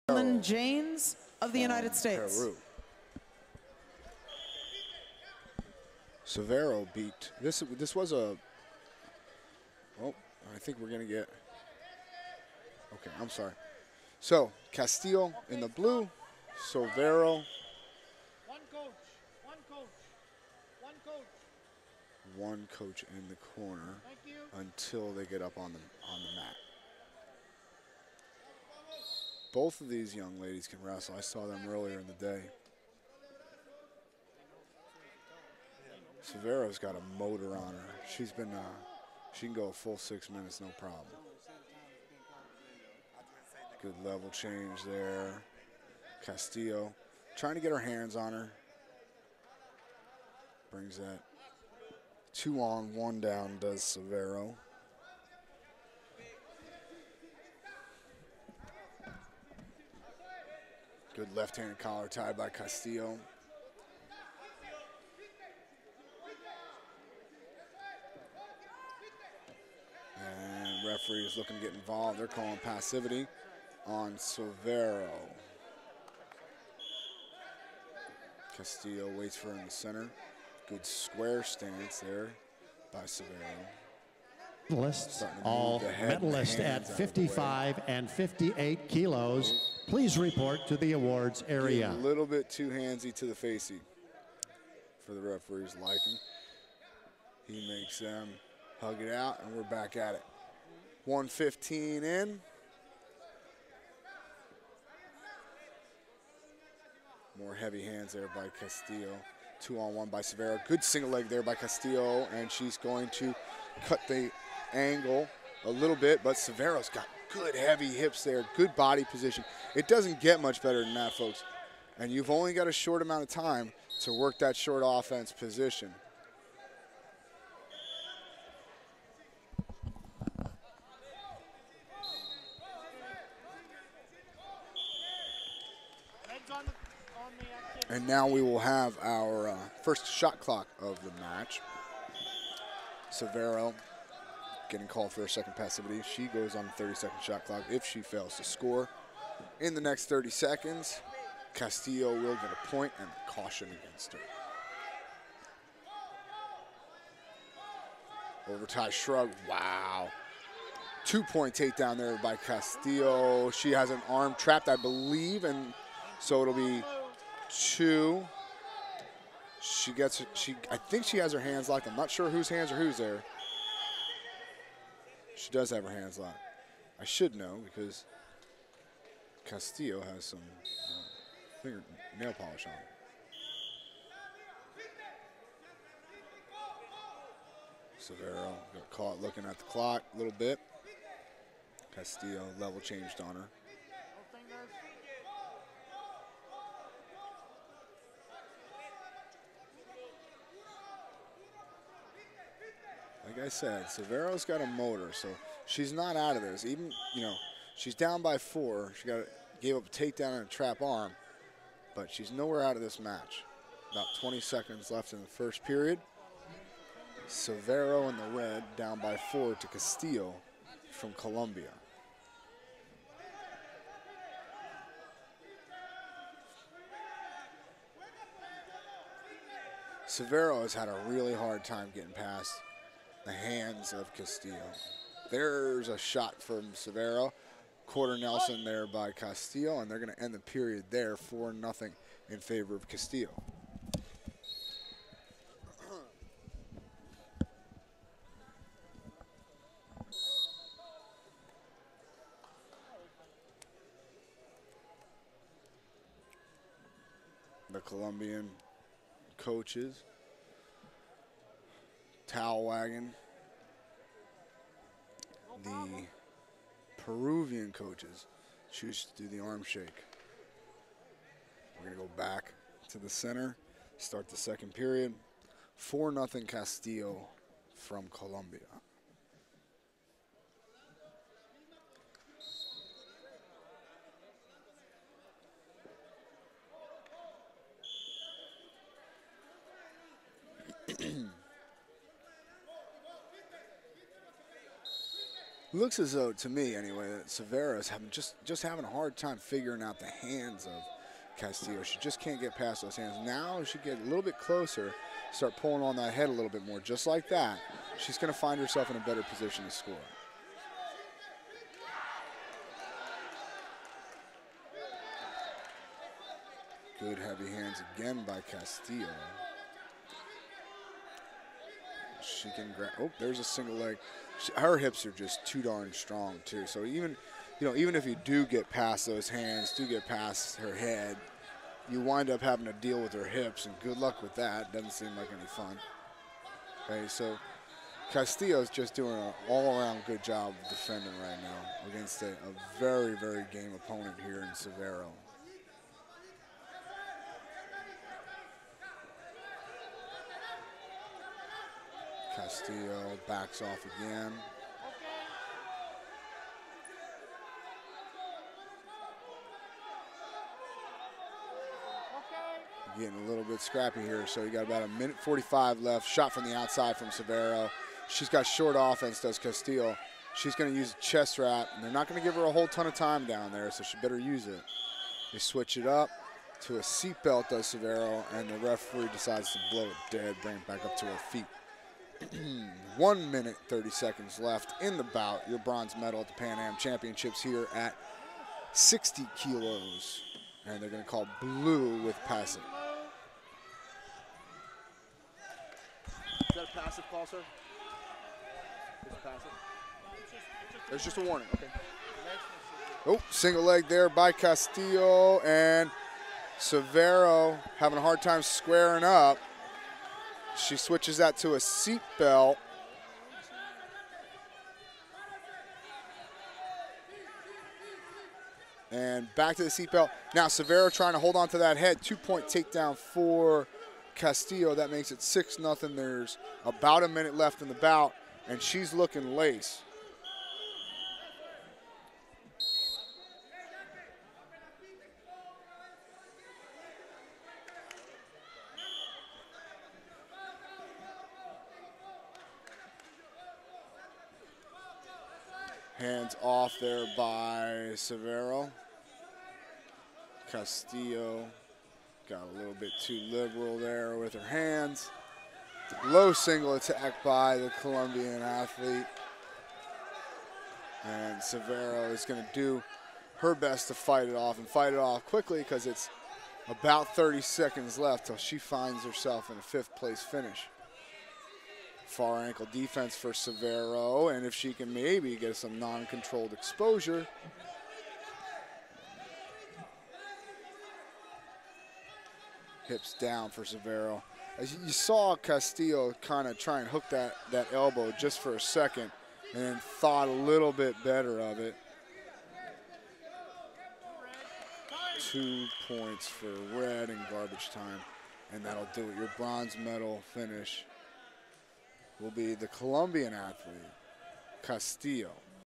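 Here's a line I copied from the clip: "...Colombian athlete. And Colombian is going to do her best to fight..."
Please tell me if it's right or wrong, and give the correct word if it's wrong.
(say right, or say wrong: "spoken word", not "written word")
wrong: "Sovero", not "Colombian".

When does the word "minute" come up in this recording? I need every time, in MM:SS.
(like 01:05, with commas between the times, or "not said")
00:40, 06:04, 06:23, 07:07.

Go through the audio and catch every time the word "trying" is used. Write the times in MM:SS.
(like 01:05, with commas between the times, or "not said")
00:47, 07:00.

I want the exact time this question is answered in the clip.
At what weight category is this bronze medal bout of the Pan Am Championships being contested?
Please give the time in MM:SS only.
06:28.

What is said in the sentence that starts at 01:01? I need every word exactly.
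Good left-handed collar tie by Castillo.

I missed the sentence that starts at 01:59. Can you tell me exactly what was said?
It doesn't get much better than that, folks.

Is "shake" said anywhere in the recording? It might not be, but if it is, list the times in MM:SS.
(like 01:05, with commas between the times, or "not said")
04:29.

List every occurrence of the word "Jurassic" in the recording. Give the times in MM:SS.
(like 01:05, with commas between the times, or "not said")
not said.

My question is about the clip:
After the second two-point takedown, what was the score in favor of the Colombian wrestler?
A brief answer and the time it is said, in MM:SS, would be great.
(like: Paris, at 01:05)
6-0, at 07:05.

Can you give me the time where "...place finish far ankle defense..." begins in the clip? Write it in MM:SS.
07:49.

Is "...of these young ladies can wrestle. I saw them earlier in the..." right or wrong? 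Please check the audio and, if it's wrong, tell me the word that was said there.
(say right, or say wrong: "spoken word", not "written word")
right.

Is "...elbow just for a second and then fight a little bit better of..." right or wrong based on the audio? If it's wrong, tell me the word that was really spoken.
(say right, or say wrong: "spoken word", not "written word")
wrong: "thought", not "fight".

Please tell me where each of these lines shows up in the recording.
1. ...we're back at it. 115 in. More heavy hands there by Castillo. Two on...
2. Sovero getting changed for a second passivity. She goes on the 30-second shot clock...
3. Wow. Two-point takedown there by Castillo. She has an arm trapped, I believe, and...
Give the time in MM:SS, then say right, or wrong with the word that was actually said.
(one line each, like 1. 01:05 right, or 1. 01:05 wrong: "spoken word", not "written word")
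1. 01:39 right
2. 02:23 wrong: "called", not "changed"
3. 02:39 right.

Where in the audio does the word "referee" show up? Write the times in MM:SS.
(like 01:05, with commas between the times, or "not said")
01:10, 01:35, 06:18.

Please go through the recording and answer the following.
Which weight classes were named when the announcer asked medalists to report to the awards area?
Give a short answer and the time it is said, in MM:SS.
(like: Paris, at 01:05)
55 and 58 kilos, at 01:26.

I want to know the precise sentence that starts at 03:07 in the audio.
Sovero got caught looking at the clock a little bit.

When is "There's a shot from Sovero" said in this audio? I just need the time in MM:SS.
03:55.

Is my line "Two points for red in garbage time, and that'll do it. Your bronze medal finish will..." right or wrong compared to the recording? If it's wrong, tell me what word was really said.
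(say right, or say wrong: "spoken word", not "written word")
right.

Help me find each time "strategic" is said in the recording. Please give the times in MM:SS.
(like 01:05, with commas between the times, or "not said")
not said.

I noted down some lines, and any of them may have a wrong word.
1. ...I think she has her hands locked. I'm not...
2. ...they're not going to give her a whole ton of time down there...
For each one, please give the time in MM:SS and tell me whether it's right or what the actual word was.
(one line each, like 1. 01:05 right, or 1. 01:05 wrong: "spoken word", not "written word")
1. 02:50 right
2. 06:11 right.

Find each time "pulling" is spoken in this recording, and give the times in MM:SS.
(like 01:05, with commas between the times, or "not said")
05:05.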